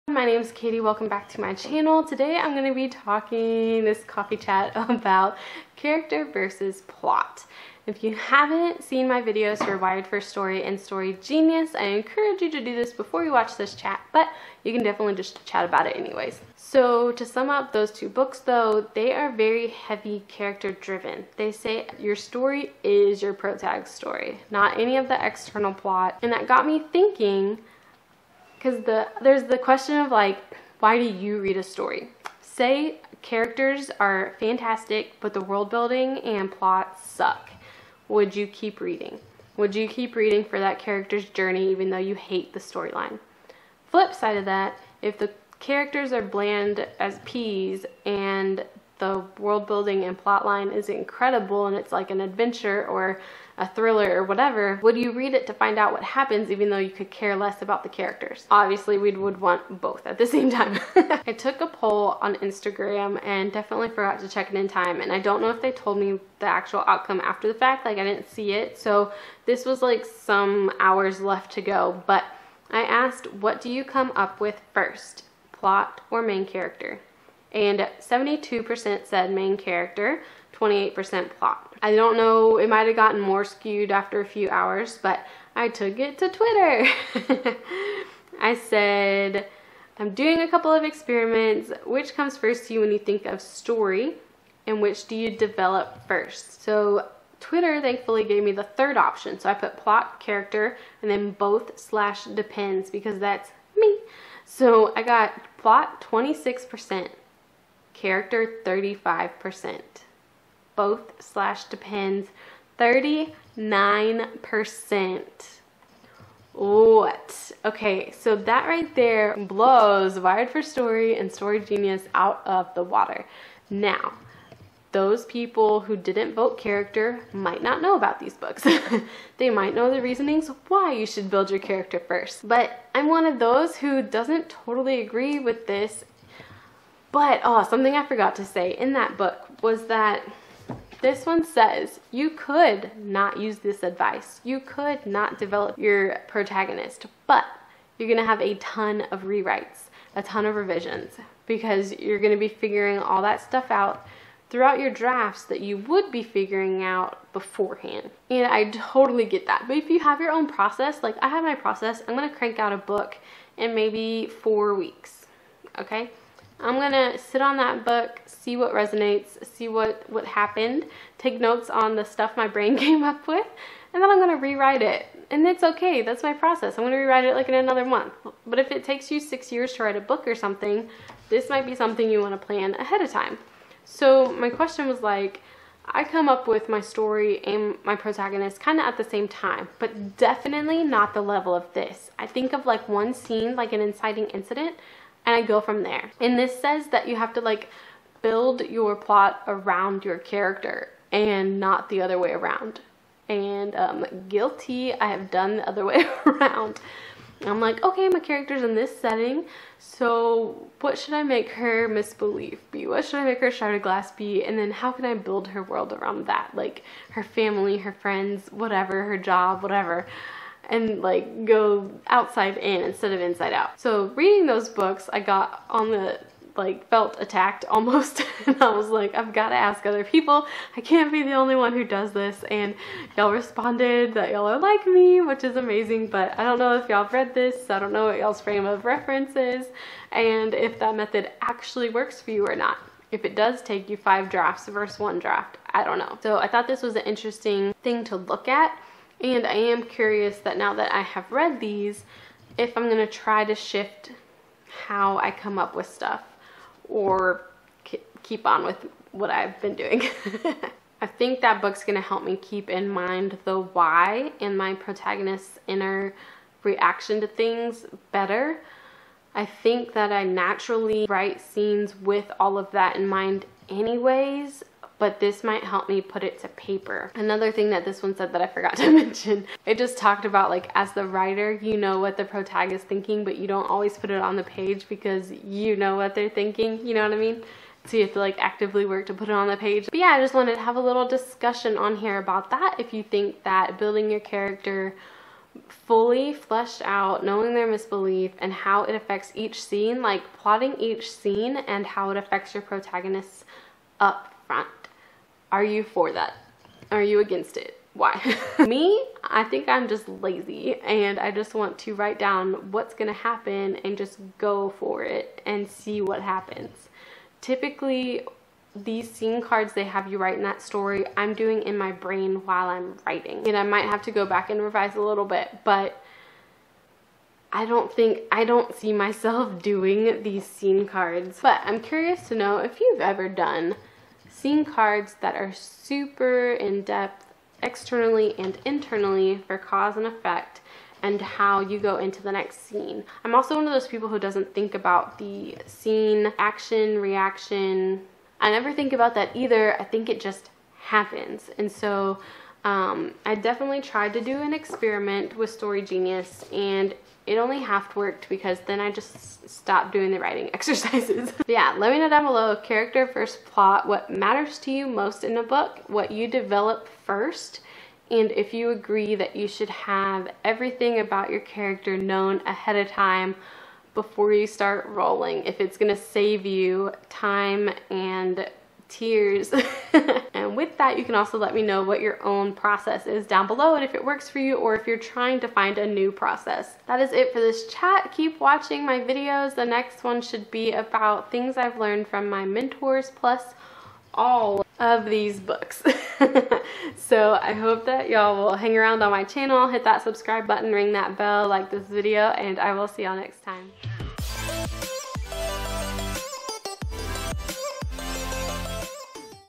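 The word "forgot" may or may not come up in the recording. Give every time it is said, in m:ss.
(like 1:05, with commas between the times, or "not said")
1:03, 2:18, 4:38.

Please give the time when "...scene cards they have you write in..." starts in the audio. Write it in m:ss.
5:19.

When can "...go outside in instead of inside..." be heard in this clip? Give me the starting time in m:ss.
3:41.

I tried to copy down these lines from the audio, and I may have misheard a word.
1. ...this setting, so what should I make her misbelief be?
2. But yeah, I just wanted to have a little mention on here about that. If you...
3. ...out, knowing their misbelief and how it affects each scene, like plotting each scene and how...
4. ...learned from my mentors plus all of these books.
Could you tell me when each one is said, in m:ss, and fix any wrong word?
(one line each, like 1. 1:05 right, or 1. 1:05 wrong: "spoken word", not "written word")
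1. 3:28 right
2. 4:49 wrong: "discussion", not "mention"
3. 4:56 right
4. 6:31 right.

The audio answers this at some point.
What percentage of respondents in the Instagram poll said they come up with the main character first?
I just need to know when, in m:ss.
1:17.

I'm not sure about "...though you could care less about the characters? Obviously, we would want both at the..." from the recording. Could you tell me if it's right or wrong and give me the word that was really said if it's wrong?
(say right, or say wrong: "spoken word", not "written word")
right.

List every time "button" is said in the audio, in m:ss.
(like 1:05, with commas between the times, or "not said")
6:40.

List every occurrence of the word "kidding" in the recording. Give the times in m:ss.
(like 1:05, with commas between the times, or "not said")
not said.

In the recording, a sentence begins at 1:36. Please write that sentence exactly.
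So Twitter thankfully gave me the third option.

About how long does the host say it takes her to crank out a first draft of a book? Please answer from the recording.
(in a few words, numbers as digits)
4 weeks.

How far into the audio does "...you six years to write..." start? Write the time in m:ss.
2:59.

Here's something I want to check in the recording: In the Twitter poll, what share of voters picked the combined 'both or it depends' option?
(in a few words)
39%.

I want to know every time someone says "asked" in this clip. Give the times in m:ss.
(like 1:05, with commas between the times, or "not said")
1:12.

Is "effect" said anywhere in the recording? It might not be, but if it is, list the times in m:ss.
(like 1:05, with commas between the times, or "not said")
5:40.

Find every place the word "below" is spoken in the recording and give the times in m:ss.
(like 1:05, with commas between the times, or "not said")
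6:02, 6:23.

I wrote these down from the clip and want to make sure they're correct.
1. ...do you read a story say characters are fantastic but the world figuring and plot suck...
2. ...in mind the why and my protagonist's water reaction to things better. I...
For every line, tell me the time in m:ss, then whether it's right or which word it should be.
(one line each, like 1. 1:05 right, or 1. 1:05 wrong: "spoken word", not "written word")
1. 0:30 wrong: "building", not "figuring"
2. 4:22 wrong: "inner", not "water".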